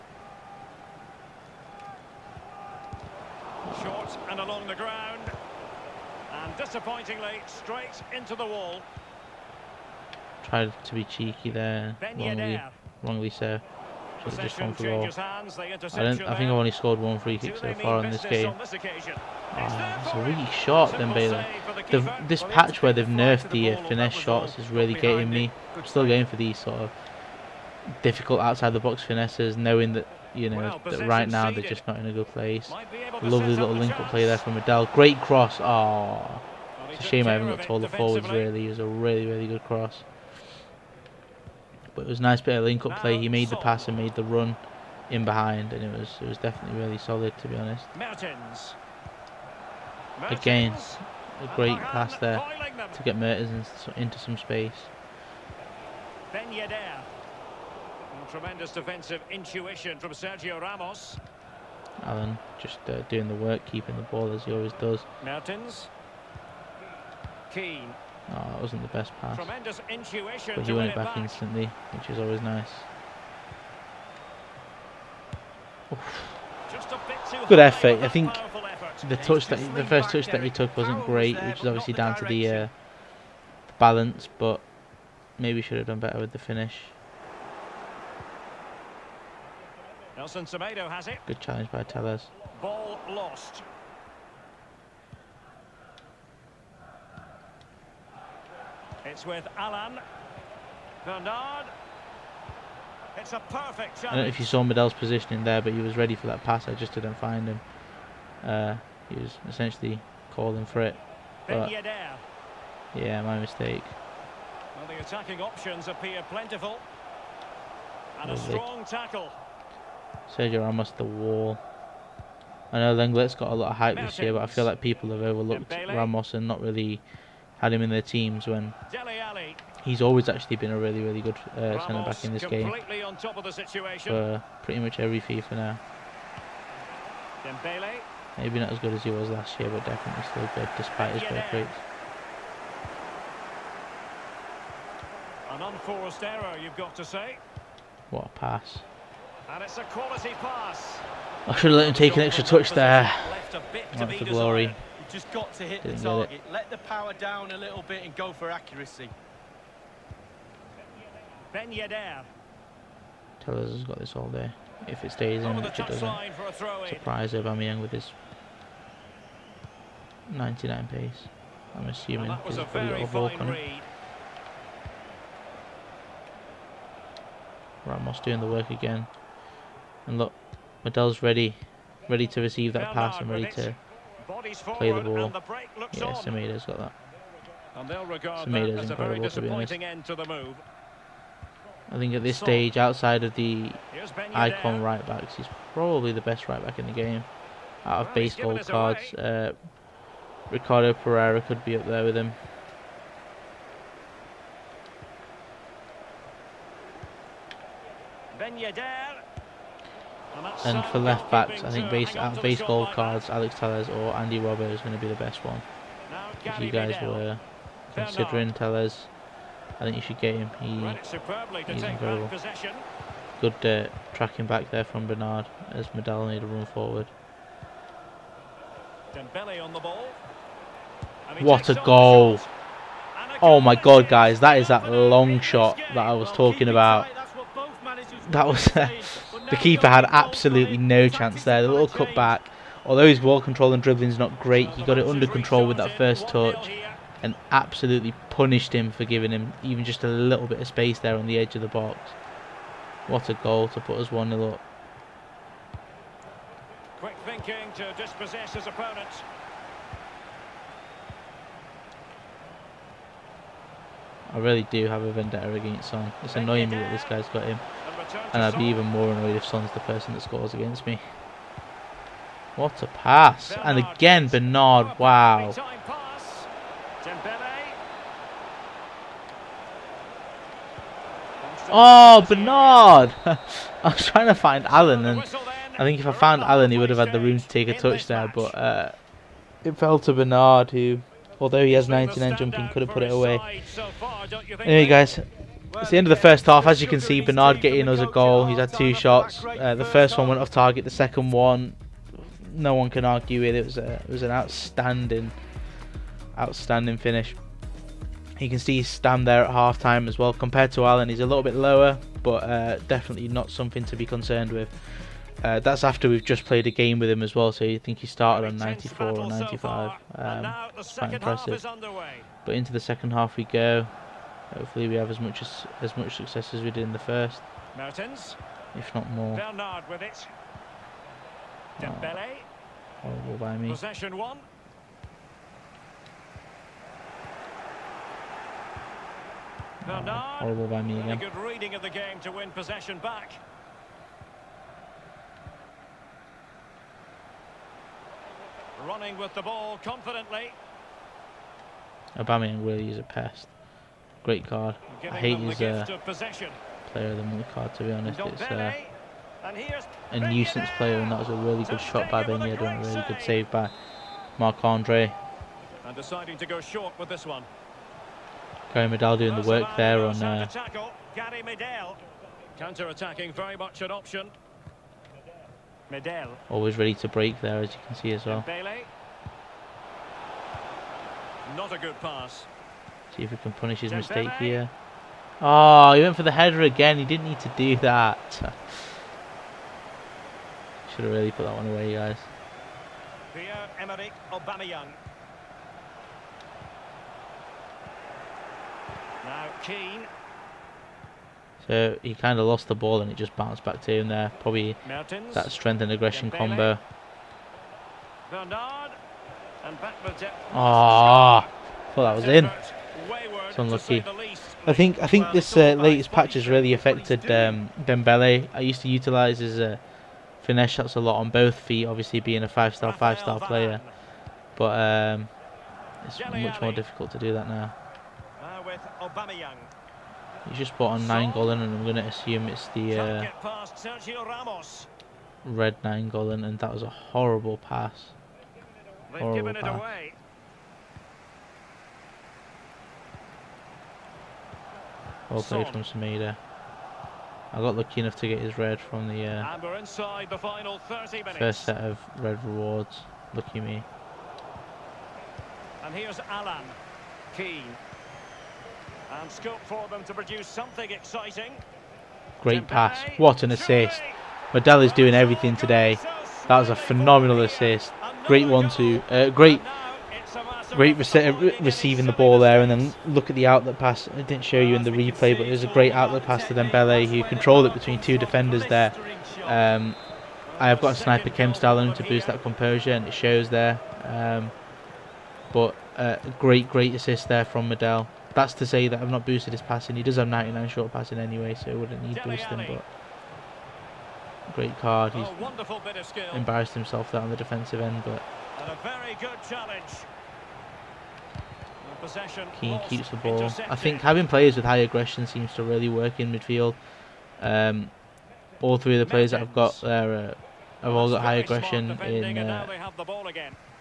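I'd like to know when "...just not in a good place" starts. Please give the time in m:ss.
0:31.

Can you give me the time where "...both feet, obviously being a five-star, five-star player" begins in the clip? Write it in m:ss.
7:01.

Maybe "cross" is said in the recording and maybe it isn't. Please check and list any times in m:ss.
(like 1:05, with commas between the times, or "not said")
0:35, 0:39.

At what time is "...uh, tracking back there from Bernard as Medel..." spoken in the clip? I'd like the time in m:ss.
3:43.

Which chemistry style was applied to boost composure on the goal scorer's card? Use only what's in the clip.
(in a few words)
Sniper.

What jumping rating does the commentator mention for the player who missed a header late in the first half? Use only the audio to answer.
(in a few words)
99.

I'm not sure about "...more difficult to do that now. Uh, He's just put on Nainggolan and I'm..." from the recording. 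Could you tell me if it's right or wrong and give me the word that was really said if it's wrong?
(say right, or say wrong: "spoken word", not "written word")
right.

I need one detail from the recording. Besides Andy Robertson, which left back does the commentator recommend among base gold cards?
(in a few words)
Alex Telles.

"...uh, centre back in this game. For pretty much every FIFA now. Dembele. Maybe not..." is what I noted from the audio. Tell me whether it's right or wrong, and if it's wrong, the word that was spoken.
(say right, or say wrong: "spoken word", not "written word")
right.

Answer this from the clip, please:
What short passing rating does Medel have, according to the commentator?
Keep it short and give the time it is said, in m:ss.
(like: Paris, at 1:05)
99, at 8:10.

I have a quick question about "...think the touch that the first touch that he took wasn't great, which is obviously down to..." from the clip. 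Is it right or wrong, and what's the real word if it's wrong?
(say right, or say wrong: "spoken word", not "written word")
right.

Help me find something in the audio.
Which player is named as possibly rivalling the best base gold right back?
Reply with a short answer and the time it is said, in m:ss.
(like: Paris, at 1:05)
Ricardo Pereira, at 3:20.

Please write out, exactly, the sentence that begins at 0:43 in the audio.
He made the pass and made the run in behind, and it was it was definitely really solid to be honest.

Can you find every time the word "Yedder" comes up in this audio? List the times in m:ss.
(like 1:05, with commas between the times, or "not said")
0:56, 2:41, 3:28, 6:02.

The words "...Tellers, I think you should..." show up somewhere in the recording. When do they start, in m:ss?
3:38.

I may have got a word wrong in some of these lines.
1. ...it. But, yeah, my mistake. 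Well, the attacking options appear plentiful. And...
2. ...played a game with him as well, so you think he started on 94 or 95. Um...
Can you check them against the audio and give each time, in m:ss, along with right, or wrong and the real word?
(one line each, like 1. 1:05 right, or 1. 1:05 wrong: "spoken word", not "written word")
1. 1:50 right
2. 5:16 right.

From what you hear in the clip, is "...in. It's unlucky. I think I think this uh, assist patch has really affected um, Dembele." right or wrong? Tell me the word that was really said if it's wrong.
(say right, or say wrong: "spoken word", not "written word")
wrong: "latest", not "assist".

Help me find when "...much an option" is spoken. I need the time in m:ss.
6:13.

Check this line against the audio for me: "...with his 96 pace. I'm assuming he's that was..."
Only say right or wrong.
wrong.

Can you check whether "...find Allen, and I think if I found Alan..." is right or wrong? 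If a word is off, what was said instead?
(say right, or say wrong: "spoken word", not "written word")
wrong: "Allen", not "Alan".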